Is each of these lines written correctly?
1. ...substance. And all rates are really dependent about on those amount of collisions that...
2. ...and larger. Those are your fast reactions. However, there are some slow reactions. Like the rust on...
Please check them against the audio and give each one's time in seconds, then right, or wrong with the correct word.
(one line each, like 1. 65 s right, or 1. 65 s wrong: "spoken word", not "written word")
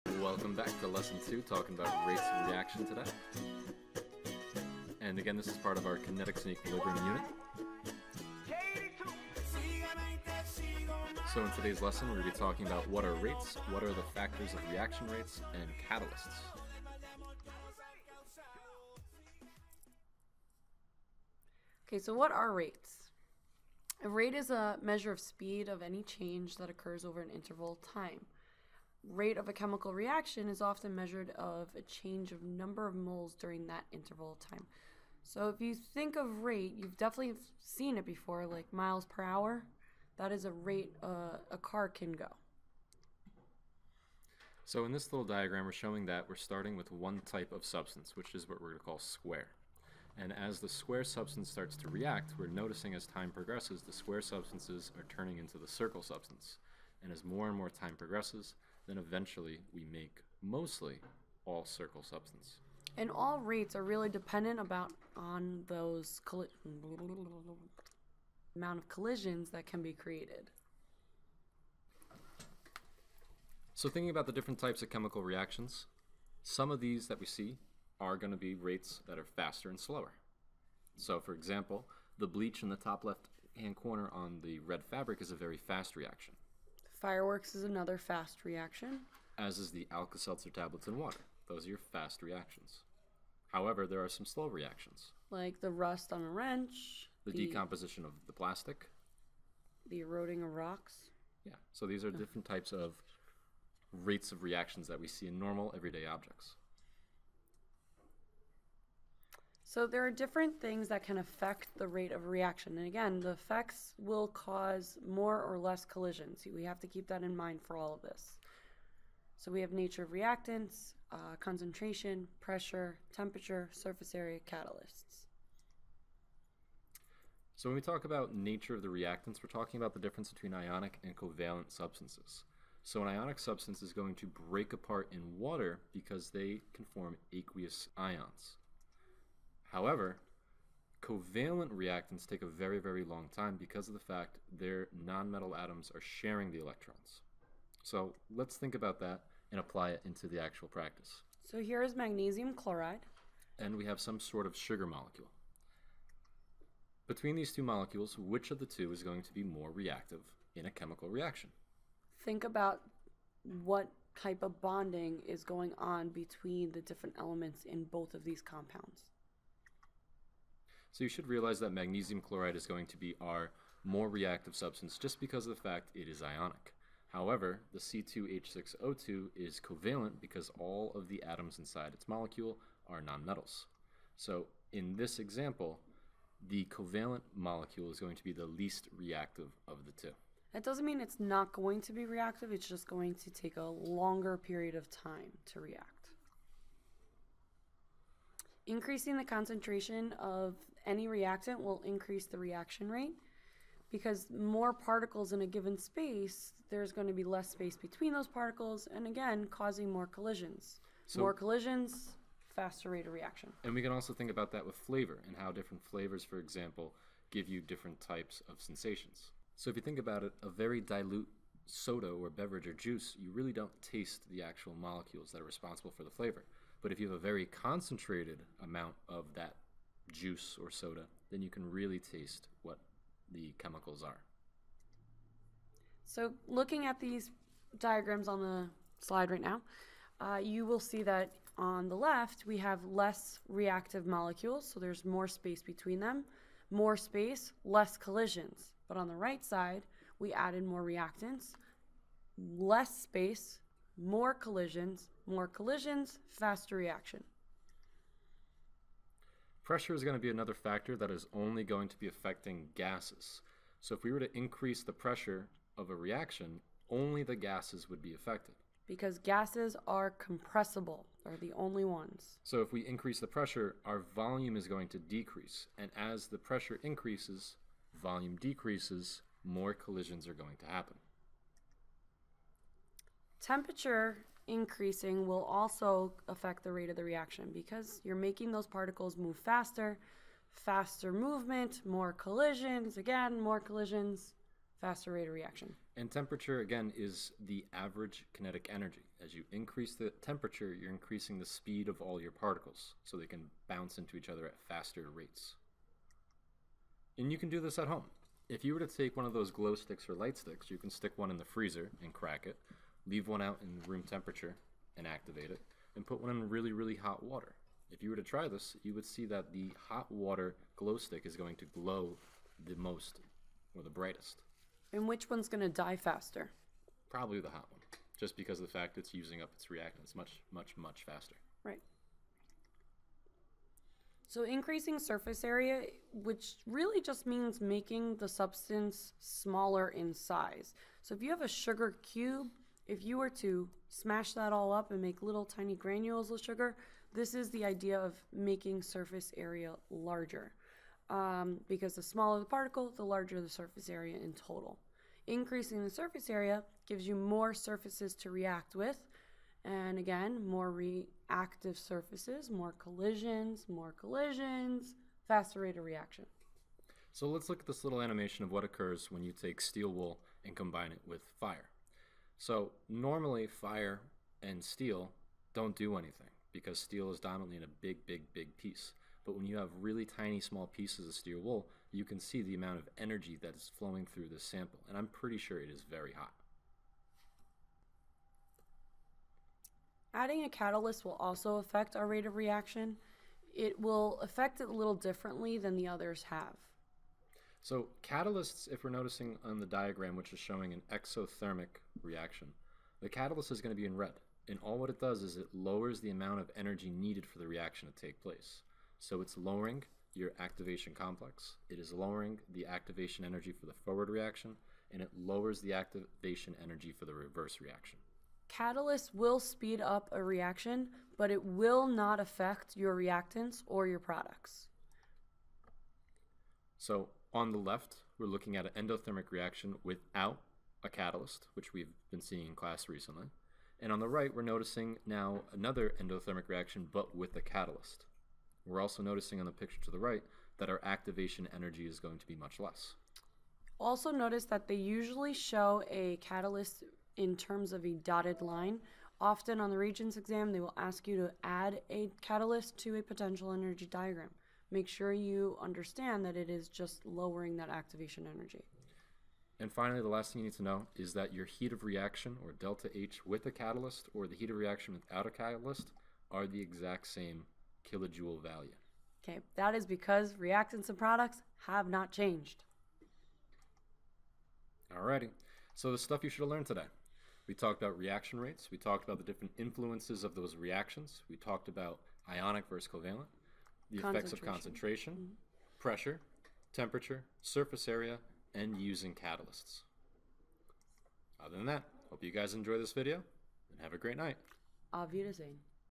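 1. 62 s right
2. 90 s wrong: "water", not "larger".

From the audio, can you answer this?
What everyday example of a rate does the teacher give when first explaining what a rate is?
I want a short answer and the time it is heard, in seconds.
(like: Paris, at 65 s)
miles per hour, at 38 s.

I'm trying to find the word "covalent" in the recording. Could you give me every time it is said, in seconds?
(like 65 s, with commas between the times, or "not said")
131 s, 141 s, 179 s, 186 s, 482 s.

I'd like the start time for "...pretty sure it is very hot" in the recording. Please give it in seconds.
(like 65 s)
385 s.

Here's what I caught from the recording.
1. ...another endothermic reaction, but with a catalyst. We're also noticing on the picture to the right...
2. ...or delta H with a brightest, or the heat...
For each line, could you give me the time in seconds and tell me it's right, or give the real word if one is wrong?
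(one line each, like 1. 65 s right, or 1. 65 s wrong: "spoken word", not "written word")
1. 435 s right
2. 462 s wrong: "catalyst", not "brightest".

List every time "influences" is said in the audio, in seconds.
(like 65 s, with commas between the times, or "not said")
479 s.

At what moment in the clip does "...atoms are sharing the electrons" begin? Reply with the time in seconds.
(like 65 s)
145 s.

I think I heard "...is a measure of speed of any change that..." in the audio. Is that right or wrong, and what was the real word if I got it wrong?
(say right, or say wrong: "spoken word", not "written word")
right.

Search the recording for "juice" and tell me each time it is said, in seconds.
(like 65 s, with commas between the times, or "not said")
222 s, 230 s.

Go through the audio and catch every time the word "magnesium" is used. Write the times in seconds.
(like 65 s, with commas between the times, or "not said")
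151 s, 171 s.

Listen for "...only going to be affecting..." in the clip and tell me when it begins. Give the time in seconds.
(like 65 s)
261 s.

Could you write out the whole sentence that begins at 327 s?
Probably the hot one, just because of the fact it's using up its reactants much, much, much faster.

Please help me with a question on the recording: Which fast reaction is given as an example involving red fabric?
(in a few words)
bleach.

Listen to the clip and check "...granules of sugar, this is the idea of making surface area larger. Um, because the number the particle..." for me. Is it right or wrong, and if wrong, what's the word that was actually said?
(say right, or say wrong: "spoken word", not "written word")
wrong: "smaller", not "number".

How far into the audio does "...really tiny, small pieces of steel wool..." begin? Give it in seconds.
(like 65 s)
379 s.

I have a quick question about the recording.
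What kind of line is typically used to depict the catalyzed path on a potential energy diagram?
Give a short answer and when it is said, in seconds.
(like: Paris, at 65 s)
dotted line, at 448 s.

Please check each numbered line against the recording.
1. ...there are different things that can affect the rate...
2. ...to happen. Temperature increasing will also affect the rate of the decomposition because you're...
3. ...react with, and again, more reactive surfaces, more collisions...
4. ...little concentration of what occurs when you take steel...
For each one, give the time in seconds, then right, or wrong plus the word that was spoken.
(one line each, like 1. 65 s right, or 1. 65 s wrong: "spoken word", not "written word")
1. 109 s right
2. 280 s wrong: "reaction", not "decomposition"
3. 358 s right
4. 367 s wrong: "animation", not "concentration".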